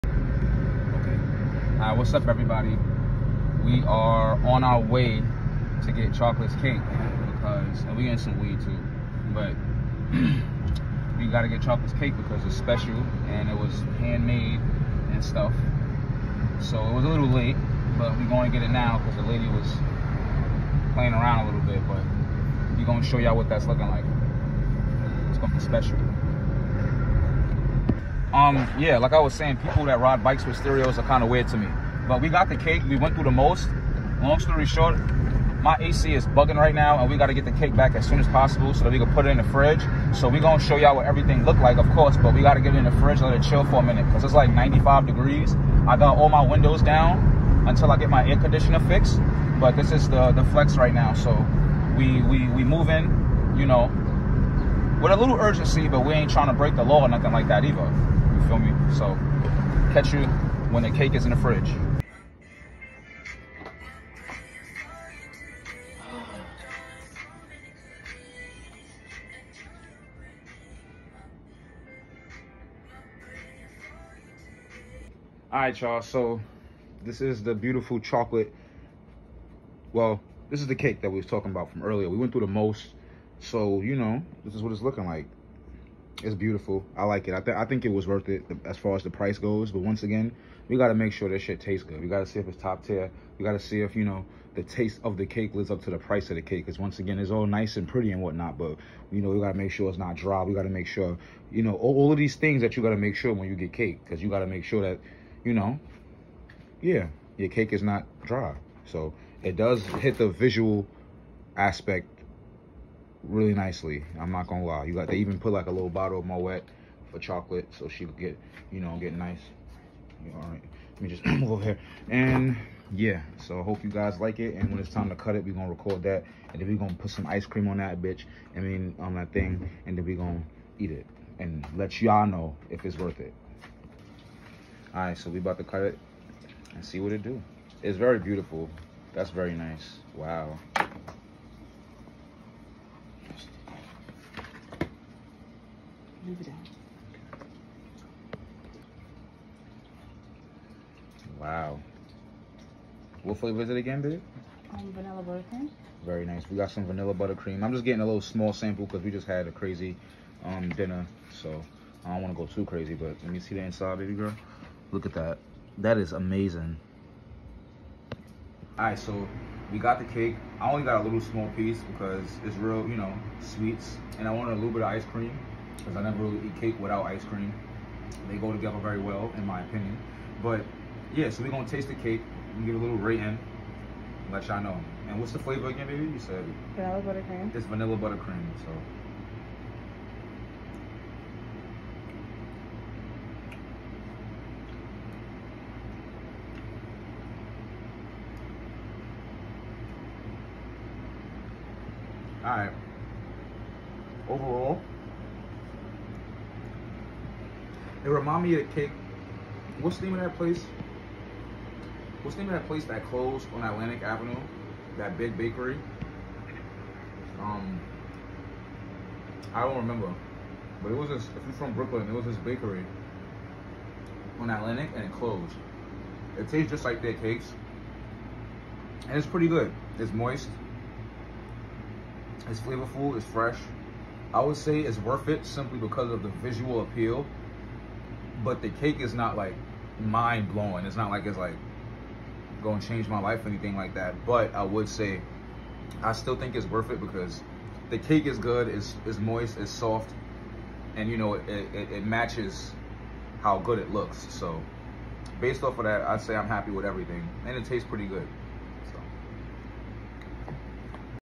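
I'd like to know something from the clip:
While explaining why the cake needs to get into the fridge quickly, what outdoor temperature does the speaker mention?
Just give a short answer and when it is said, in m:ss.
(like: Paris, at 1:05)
95 degrees, at 0:44.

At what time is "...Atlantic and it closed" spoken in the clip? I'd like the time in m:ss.
3:44.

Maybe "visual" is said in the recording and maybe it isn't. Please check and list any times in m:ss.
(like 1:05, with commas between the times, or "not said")
1:50, 3:56.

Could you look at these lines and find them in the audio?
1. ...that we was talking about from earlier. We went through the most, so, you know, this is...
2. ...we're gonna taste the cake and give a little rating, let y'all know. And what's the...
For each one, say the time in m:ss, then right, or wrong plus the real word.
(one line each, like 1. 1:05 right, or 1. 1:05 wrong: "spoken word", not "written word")
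1. 1:21 right
2. 3:01 right.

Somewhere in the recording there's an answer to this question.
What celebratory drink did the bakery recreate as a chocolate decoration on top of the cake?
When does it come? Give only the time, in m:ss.
1:56.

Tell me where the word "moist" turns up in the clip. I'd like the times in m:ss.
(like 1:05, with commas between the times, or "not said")
3:50, 4:09.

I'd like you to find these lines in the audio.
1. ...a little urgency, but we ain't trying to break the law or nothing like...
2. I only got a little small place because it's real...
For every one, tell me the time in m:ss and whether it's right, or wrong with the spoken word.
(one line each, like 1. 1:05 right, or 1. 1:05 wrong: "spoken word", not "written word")
1. 0:55 right
2. 2:50 wrong: "piece", not "place".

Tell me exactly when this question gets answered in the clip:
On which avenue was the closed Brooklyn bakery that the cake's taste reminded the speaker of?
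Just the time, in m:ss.
3:33.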